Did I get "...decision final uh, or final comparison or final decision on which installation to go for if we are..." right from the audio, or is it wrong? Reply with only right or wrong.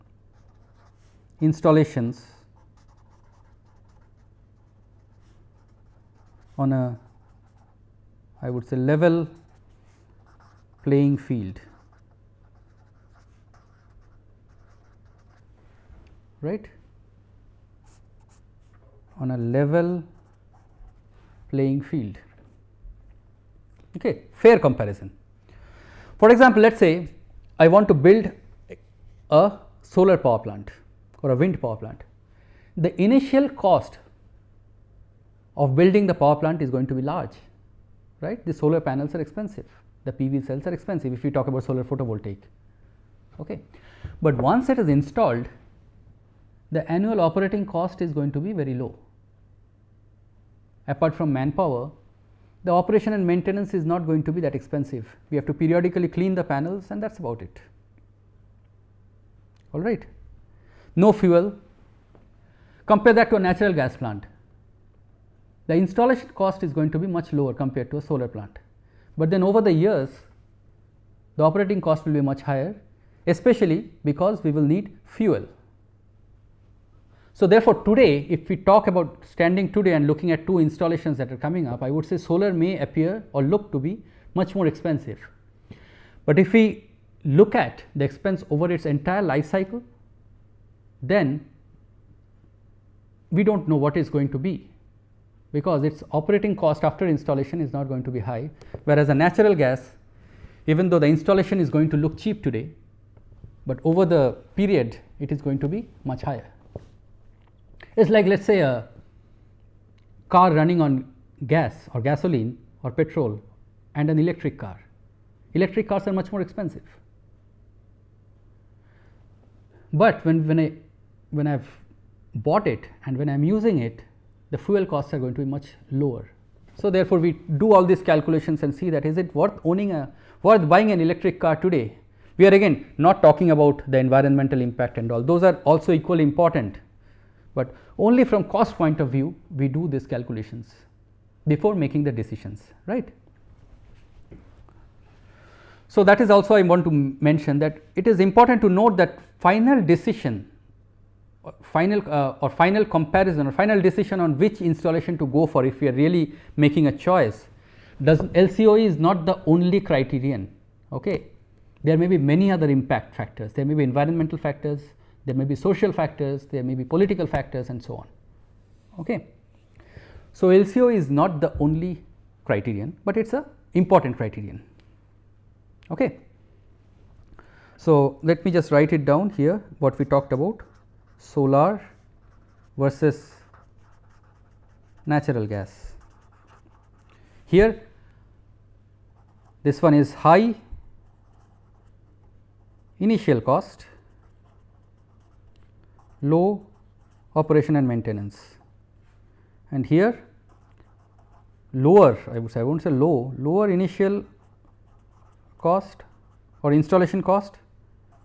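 right.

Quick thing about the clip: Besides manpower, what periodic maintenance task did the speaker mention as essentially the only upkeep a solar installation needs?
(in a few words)
clean the panels.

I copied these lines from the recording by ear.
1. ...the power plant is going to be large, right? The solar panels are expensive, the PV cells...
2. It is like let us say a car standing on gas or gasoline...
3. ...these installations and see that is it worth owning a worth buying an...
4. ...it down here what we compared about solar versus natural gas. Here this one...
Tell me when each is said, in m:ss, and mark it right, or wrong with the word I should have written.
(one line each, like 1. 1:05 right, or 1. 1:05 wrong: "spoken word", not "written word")
1. 0:36 right
2. 1:47 wrong: "running", not "standing"
3. 2:07 wrong: "calculations", not "installations"
4. 2:58 wrong: "talked", not "compared".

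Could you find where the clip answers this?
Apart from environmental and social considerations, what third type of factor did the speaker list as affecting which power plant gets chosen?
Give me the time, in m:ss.
2:46.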